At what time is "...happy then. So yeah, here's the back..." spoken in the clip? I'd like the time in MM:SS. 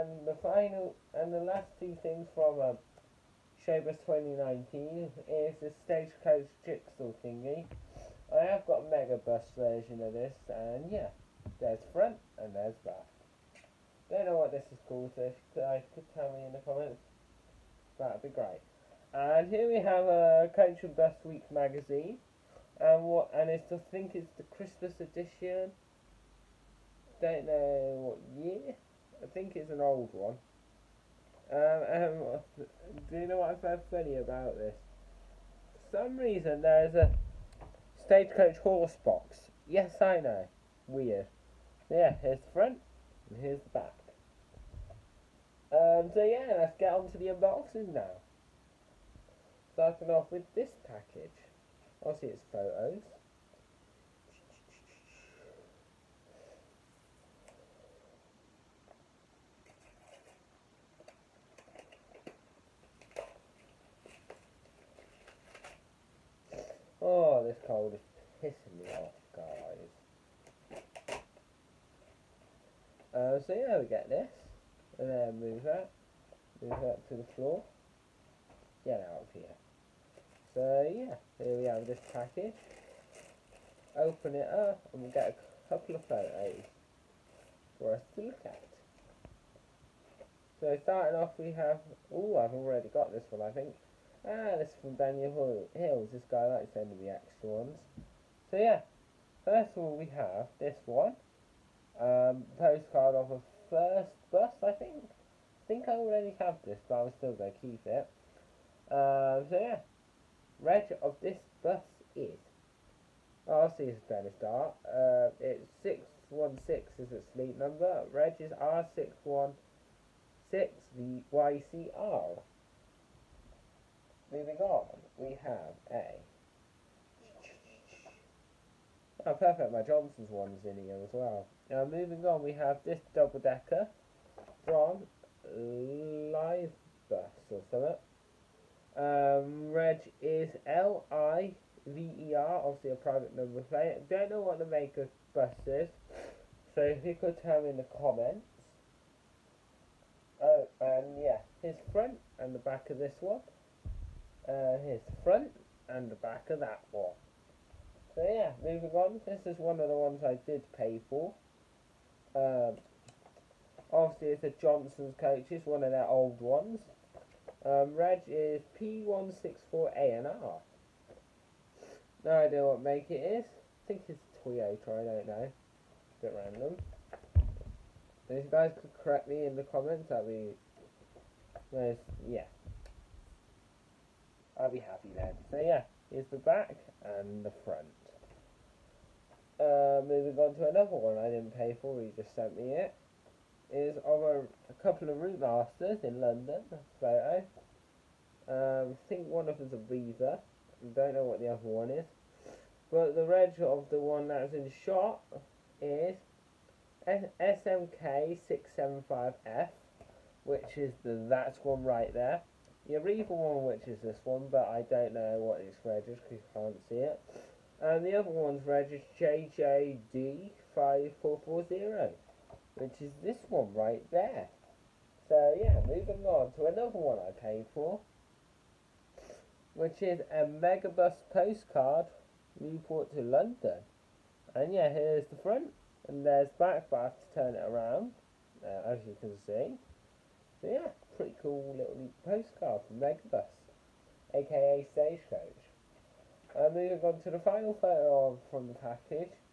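03:04.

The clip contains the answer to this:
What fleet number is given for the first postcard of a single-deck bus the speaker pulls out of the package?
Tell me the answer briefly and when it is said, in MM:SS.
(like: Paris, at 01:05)
616, at 01:55.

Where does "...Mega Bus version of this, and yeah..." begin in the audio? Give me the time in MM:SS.
00:08.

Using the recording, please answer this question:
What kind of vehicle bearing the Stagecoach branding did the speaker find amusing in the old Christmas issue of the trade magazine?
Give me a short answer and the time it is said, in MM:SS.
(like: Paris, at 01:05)
Horse box, at 00:38.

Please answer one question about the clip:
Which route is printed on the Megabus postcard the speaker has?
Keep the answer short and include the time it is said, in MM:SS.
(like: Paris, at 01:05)
Newport to London, at 03:52.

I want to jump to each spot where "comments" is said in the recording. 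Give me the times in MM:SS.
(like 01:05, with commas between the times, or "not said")
00:16, 02:27, 02:59.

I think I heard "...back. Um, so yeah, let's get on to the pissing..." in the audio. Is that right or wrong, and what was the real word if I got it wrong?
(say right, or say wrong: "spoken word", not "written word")
wrong: "unboxing", not "pissing".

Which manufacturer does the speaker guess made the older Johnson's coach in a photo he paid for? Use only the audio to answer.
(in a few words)
Toyota.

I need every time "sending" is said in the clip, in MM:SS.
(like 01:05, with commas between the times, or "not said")
01:36.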